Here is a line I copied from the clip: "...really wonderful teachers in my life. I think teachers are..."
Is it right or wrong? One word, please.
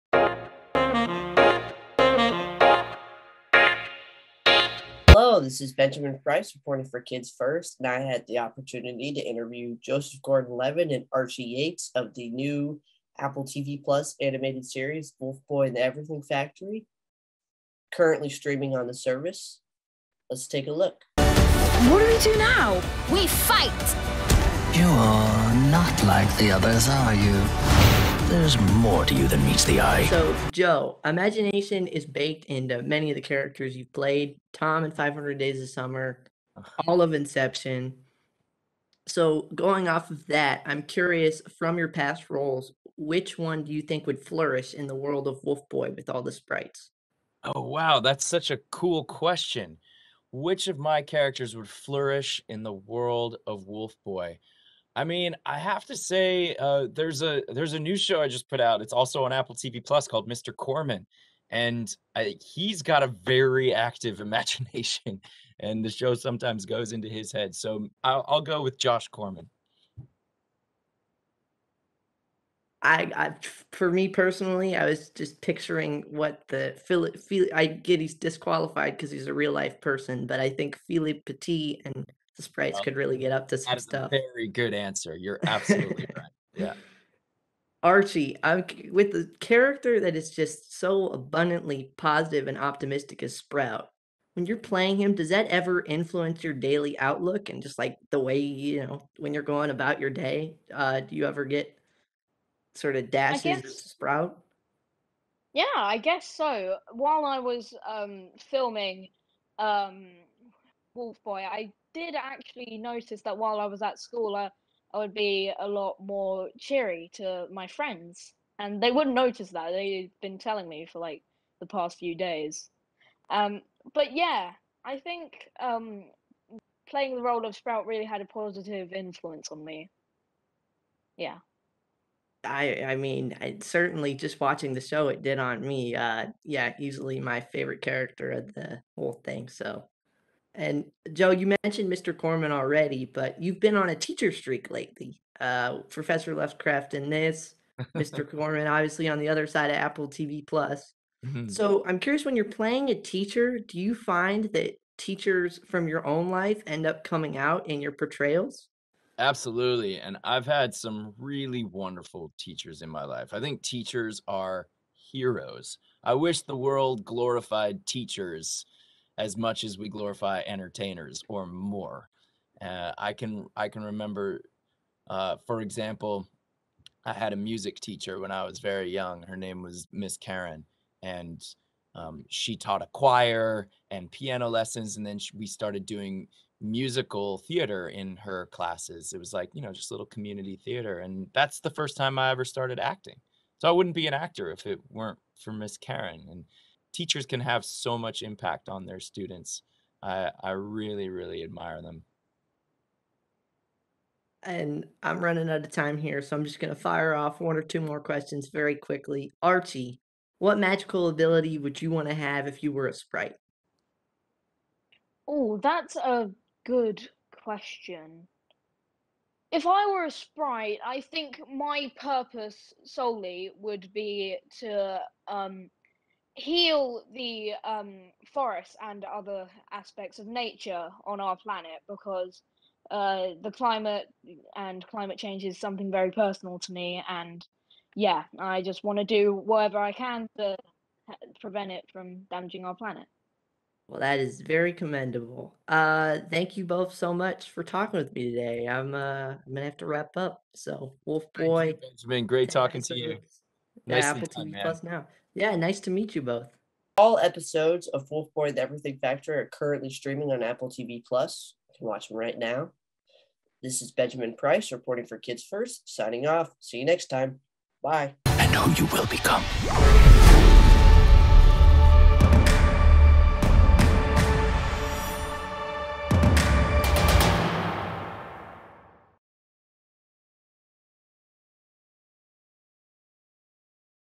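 right.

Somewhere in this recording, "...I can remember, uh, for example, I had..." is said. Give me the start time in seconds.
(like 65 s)
173 s.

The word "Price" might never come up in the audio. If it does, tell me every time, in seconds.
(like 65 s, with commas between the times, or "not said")
6 s, 264 s.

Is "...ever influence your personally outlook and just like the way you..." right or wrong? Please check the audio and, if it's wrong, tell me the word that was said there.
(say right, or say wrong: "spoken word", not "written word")
wrong: "daily", not "personally".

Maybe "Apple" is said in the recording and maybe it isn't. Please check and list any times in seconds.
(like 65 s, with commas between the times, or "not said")
13 s, 59 s, 149 s, 254 s, 260 s.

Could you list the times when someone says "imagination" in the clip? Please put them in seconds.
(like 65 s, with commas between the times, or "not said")
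31 s, 64 s.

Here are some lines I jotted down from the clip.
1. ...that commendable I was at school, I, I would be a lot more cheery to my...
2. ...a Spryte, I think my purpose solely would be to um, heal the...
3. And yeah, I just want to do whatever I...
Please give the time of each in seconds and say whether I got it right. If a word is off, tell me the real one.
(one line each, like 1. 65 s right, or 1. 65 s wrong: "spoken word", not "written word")
1. 113 s wrong: "while", not "commendable"
2. 220 s right
3. 237 s right.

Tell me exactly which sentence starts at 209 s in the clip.
Archie, what magical ability would you want to have if you were a Spryte?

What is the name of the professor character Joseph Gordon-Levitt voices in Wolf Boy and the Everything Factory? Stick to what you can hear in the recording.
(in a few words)
Professor Luxcraft.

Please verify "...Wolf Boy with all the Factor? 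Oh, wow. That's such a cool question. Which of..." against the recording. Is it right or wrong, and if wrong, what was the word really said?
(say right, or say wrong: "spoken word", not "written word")
wrong: "Sprytes", not "Factor".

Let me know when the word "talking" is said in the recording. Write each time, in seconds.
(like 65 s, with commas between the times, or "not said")
247 s, 252 s.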